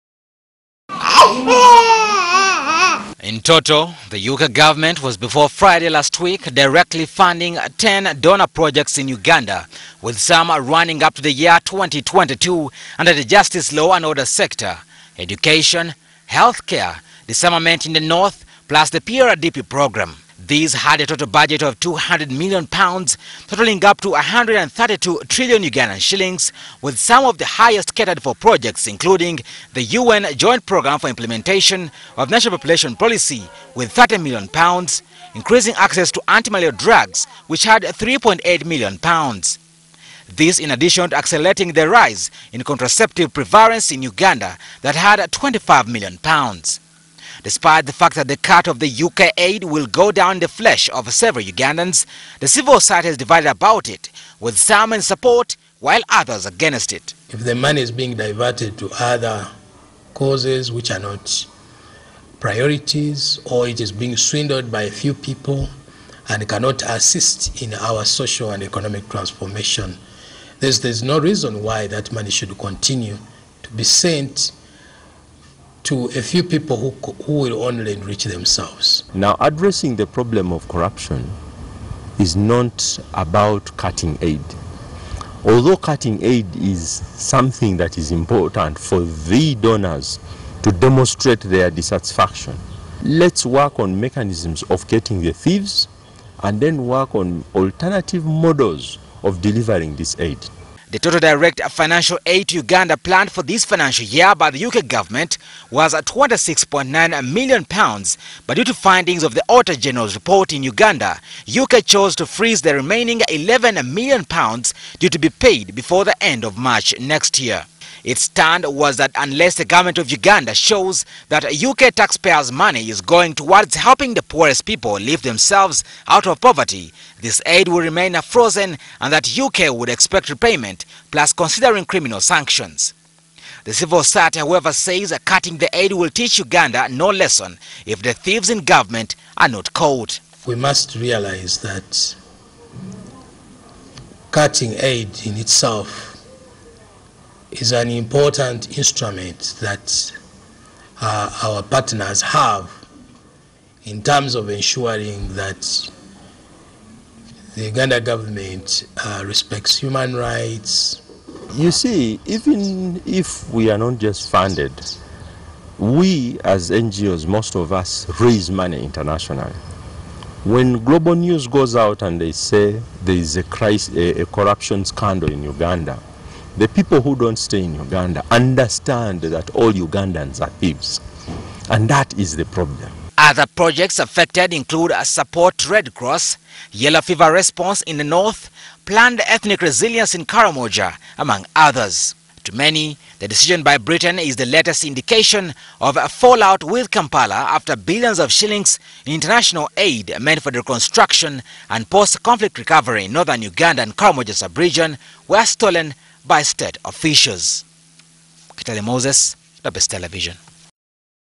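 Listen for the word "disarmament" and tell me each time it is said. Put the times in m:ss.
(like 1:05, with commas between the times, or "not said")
0:17.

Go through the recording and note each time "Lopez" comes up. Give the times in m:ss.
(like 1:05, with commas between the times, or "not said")
3:29.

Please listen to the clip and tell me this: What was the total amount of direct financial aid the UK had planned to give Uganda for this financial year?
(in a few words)
£26.9 million.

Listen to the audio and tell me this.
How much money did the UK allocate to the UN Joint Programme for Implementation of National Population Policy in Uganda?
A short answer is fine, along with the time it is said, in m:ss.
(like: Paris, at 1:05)
30 million pounds, at 0:33.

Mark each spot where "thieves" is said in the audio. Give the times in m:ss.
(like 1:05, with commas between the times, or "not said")
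1:35, 2:18, 3:00.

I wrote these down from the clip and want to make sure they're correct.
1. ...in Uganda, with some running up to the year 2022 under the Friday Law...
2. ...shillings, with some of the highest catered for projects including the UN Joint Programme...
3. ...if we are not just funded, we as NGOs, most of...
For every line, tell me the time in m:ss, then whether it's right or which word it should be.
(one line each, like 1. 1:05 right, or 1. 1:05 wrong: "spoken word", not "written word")
1. 0:08 wrong: "Justice", not "Friday"
2. 0:26 right
3. 2:43 right.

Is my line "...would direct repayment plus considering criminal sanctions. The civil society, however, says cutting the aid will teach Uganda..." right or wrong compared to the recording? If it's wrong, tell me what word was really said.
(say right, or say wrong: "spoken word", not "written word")
wrong: "expect", not "direct".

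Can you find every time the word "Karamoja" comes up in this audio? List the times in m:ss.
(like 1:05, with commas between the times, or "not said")
3:10, 3:23.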